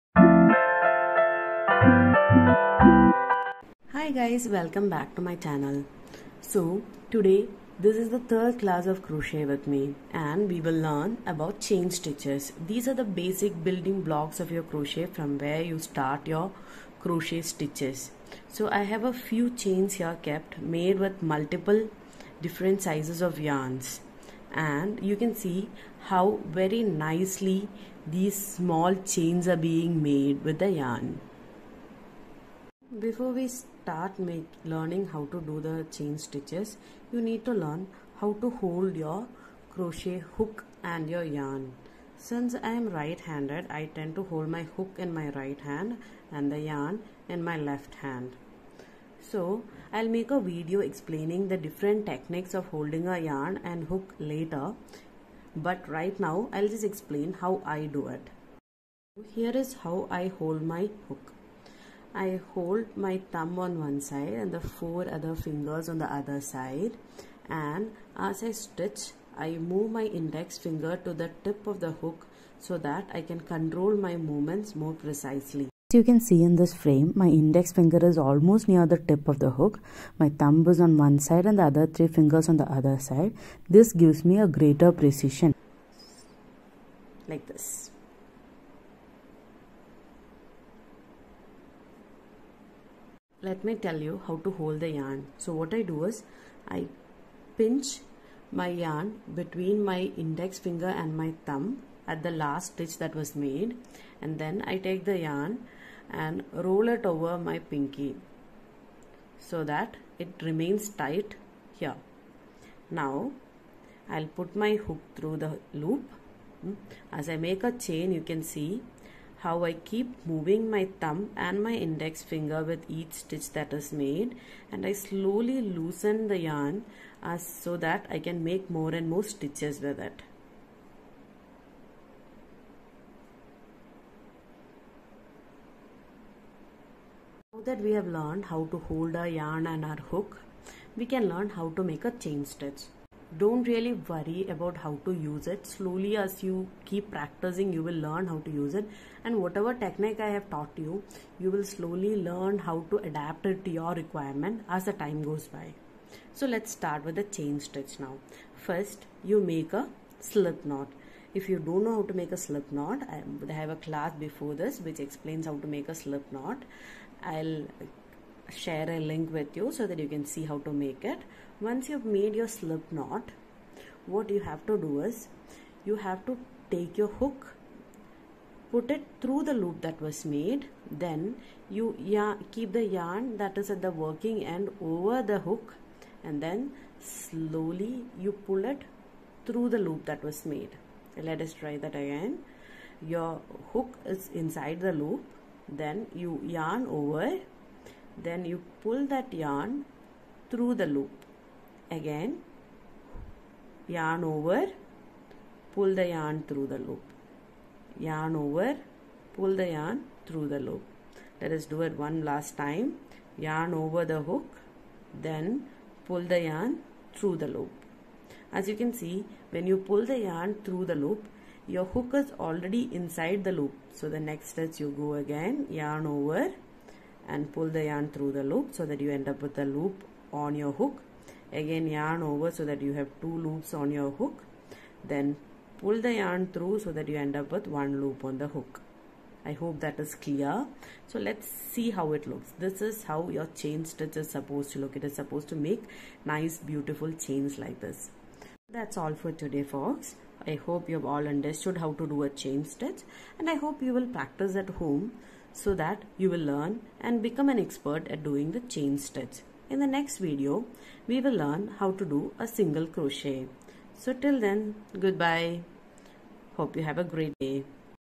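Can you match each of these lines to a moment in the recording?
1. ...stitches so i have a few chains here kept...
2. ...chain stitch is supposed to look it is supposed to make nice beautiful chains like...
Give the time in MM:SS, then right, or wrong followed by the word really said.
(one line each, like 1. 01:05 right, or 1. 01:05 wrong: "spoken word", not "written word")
1. 00:17 right
2. 04:03 right.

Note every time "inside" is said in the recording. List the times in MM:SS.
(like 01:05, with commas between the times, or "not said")
03:14, 03:42.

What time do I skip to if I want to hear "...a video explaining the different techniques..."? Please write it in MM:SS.
00:50.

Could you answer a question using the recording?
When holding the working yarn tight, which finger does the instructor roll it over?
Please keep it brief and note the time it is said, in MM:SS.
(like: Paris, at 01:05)
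pinky, at 01:47.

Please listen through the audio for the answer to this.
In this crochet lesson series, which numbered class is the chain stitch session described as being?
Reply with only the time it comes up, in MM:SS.
00:08.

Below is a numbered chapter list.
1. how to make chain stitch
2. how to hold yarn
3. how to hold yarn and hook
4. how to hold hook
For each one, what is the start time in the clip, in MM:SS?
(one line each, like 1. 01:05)
1. 02:18
2. 01:34
3. 00:34
4. 01:00.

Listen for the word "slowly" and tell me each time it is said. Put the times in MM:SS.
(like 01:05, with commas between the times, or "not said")
02:04, 02:25, 02:31, 03:06.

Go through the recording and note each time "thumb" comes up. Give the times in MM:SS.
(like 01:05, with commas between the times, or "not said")
01:03, 01:20, 01:41, 02:01.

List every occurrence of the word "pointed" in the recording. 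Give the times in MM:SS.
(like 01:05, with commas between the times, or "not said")
not said.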